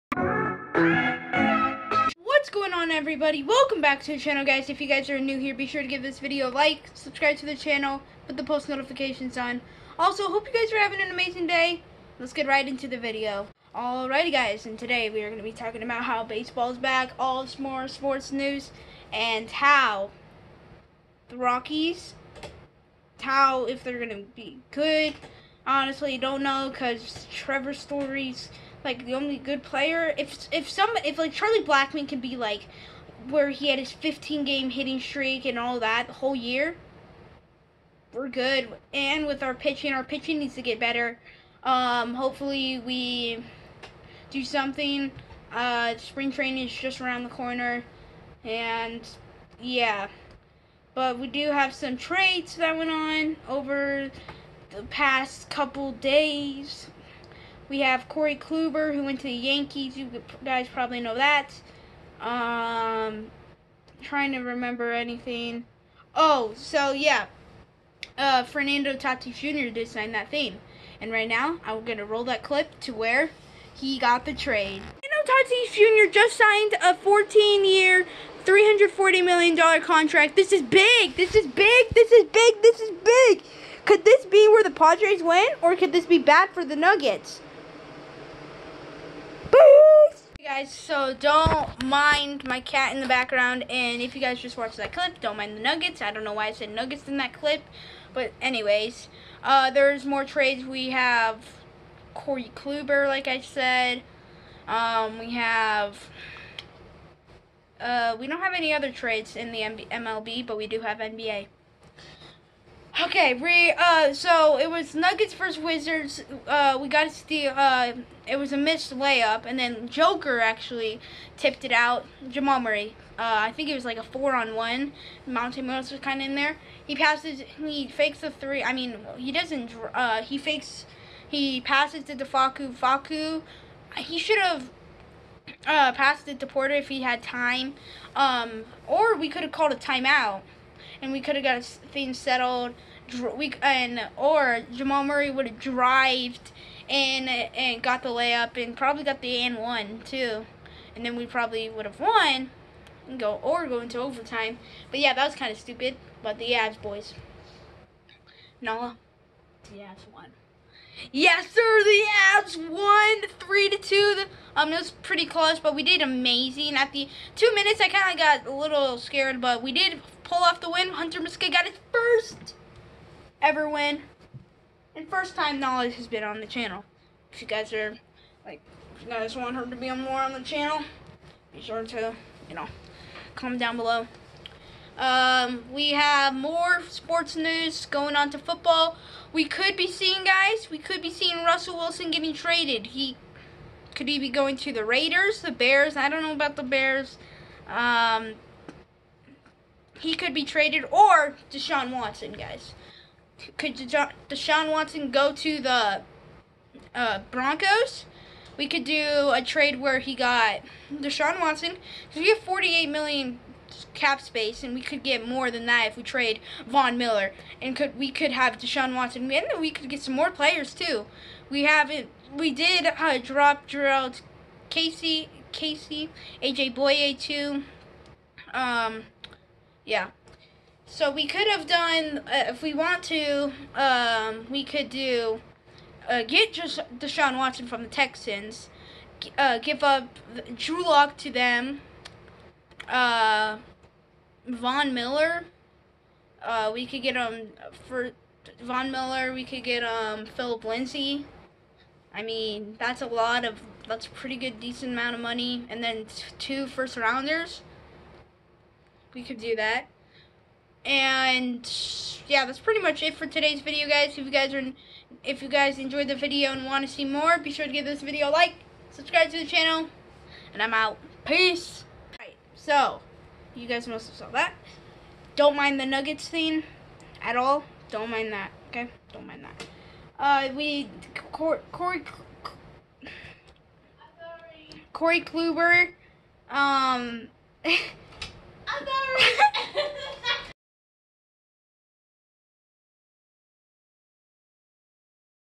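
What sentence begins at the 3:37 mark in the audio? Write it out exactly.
And could we could have Deshaun Watson, and we could get some more players too.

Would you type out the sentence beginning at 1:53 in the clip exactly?
Okay, we uh, so it was Nuggets versus Wizards.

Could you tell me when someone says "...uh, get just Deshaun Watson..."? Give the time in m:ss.
3:56.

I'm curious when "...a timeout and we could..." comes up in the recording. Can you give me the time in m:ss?
2:19.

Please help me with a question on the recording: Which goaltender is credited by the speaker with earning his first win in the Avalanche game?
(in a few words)
Hunter Miska.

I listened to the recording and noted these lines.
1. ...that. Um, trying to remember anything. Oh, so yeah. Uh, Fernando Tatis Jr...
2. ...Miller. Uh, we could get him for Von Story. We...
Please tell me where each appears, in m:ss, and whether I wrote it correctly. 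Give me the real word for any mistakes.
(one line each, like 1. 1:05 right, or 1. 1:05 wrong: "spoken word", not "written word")
1. 1:01 right
2. 4:04 wrong: "Miller", not "Story".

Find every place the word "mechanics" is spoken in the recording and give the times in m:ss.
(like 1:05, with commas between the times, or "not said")
not said.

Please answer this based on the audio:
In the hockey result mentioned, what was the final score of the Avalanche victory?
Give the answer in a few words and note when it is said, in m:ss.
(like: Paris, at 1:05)
3 to 2, at 2:43.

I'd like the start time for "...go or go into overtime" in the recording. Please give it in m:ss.
2:33.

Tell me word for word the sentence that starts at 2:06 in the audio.
He passes, he fakes the three.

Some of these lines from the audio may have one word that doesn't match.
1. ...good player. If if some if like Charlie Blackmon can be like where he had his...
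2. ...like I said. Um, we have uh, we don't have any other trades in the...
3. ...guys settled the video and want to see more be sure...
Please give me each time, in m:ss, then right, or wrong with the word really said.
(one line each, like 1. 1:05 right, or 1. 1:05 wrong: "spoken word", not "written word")
1. 0:29 right
2. 1:43 right
3. 4:25 wrong: "enjoyed", not "settled".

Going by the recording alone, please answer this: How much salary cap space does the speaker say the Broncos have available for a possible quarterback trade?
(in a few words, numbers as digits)
48 million.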